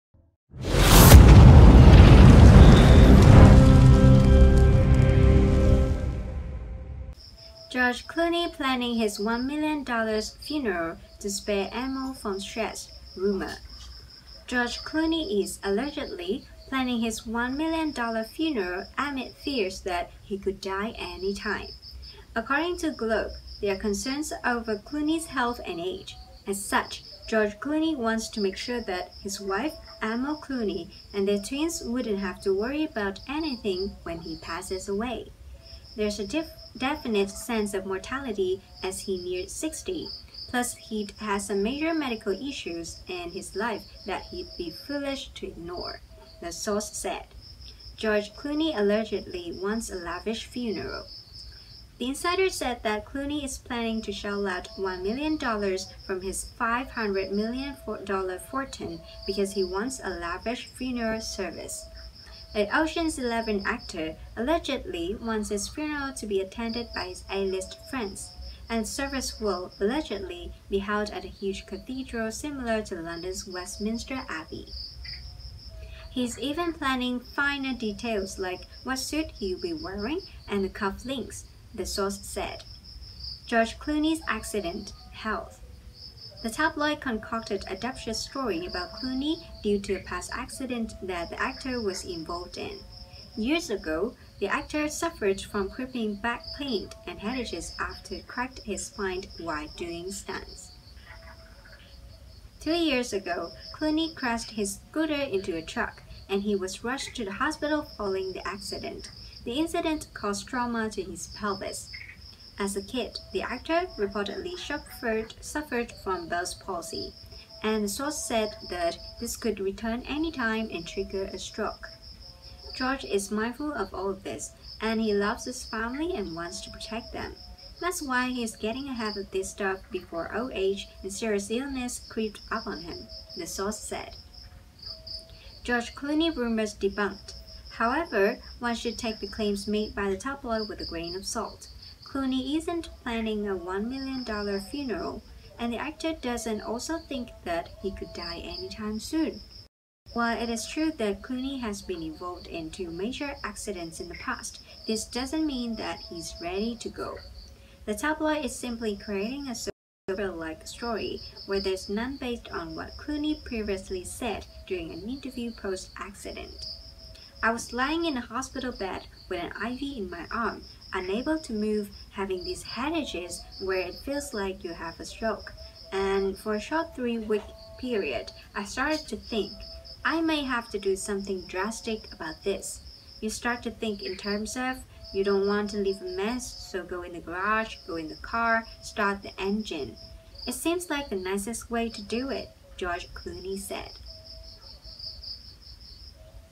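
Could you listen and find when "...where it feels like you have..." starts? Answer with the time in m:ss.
2:53.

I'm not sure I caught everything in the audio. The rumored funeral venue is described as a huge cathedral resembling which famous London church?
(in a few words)
Westminster Abbey.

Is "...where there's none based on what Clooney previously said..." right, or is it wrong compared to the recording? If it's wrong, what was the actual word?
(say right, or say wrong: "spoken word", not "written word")
right.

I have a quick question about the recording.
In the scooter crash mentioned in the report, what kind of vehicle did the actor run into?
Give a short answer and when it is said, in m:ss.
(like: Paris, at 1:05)
a truck, at 1:45.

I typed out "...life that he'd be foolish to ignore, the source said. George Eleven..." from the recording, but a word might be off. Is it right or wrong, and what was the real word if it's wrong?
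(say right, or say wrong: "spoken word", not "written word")
wrong: "Clooney", not "Eleven".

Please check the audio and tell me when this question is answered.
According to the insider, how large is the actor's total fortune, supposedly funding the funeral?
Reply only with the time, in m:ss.
0:56.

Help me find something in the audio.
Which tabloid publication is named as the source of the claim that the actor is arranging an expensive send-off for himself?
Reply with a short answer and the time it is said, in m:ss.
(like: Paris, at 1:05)
Globe, at 0:22.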